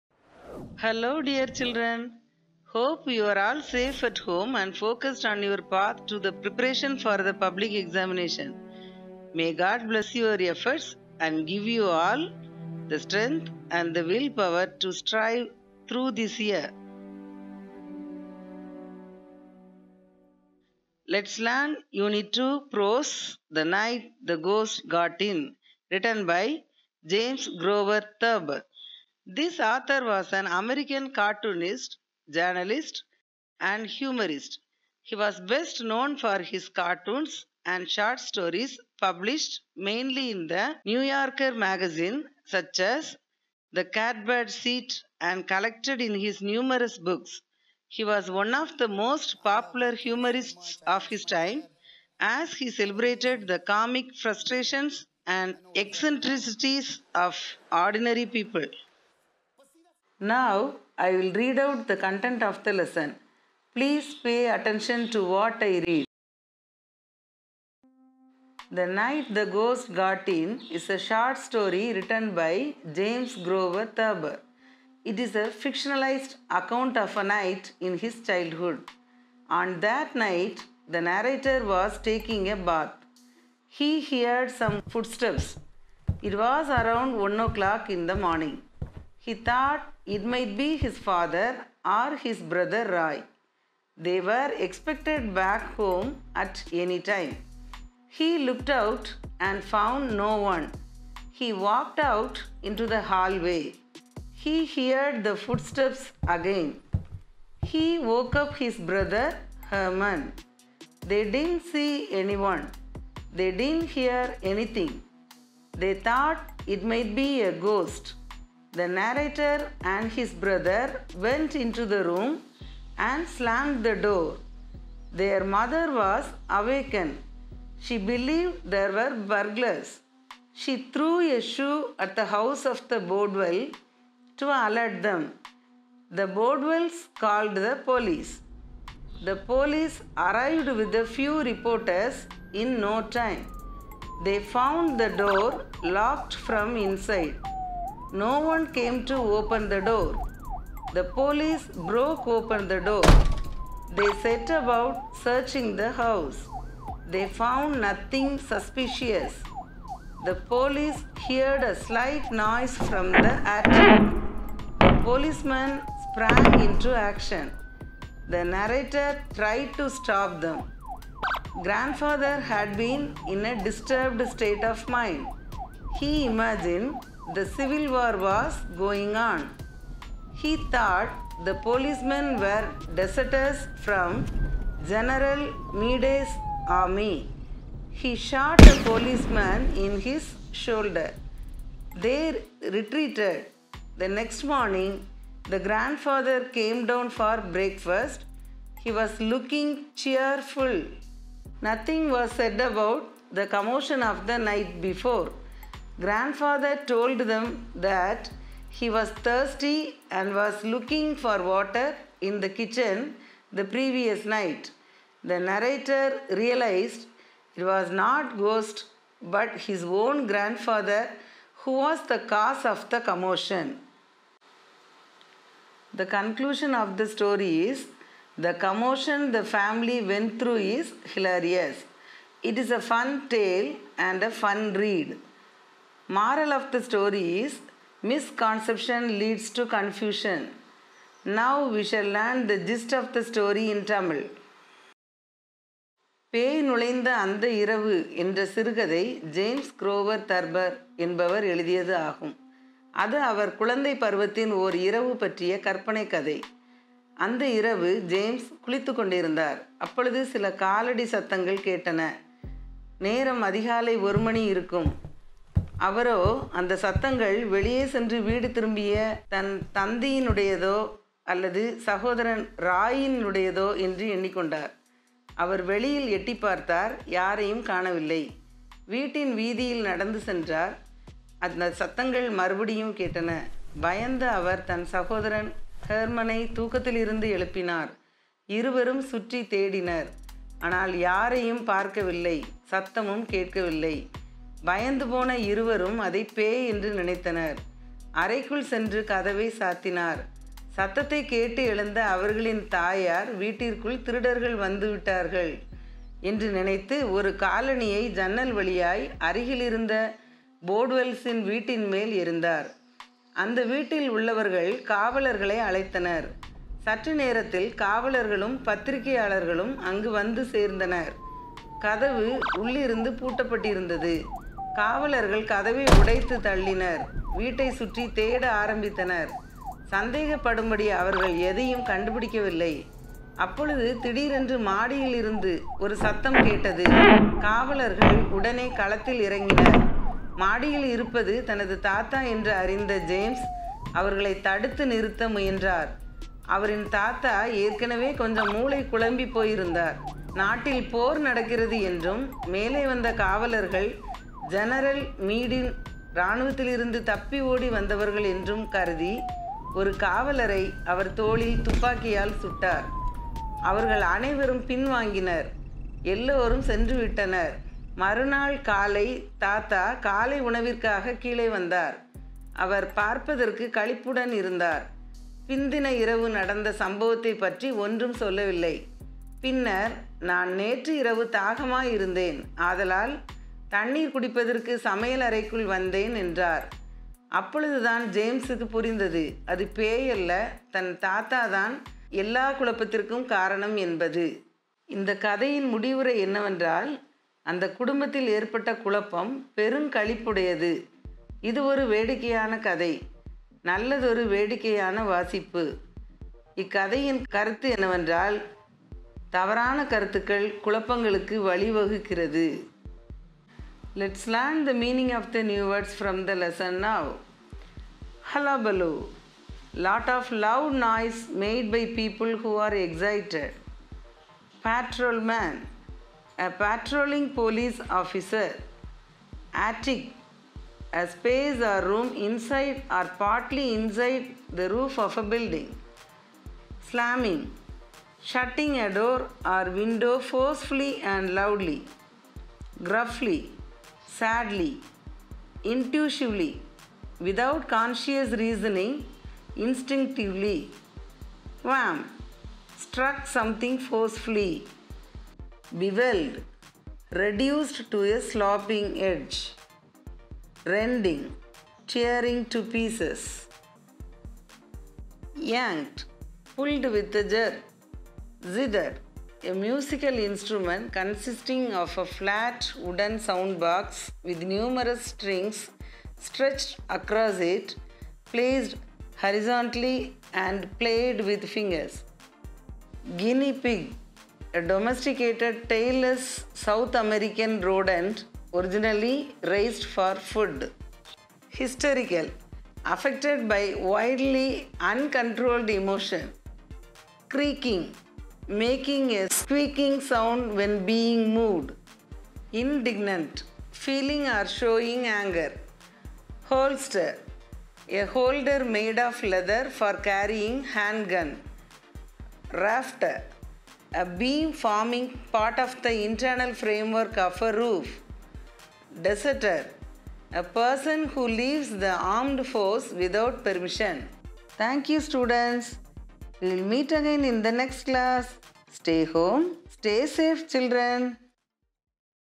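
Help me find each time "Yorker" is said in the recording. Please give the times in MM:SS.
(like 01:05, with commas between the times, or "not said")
00:41.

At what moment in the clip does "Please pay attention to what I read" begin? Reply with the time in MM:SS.
01:03.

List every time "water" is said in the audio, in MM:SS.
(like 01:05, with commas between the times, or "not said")
03:31.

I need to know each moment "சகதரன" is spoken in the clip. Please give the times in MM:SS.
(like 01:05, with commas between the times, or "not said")
04:31, 04:44.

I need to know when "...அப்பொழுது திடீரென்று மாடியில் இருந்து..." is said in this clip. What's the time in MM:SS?
05:33.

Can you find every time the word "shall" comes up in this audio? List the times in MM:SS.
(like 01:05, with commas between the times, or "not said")
04:01.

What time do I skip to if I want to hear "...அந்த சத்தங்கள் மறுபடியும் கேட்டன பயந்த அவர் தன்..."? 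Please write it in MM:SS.
04:41.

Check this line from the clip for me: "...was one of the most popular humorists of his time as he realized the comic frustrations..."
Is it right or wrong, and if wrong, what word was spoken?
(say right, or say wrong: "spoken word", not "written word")
wrong: "celebrated", not "realized".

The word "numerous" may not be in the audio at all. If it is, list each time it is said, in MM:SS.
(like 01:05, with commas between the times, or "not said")
00:46, 07:54.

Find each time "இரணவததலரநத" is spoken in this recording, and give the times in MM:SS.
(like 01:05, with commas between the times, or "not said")
05:56.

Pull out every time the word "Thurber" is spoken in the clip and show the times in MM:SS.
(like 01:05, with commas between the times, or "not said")
00:28, 01:13.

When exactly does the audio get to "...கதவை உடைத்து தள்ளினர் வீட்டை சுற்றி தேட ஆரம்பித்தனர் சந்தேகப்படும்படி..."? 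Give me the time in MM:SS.
05:25.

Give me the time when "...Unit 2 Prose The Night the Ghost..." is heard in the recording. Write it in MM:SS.
00:21.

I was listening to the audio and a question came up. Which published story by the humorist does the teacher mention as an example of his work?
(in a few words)
The Catbird Seat.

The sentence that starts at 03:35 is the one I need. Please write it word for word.
The narrator realized it was not ghost but his own grandfather who was the cause of the commotion.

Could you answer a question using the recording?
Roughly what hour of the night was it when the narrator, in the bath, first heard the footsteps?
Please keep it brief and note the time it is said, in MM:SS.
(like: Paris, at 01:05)
1 o'clock, at 01:27.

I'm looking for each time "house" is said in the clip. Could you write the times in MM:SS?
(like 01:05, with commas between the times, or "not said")
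02:12, 02:35.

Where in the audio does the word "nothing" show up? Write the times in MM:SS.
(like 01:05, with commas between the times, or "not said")
02:37, 03:21.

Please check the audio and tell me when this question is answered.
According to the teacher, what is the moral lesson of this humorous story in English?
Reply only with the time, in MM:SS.
03:58.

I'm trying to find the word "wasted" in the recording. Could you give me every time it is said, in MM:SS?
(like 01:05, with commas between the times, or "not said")
not said.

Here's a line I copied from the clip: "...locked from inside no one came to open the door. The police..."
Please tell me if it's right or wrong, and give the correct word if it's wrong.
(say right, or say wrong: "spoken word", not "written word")
right.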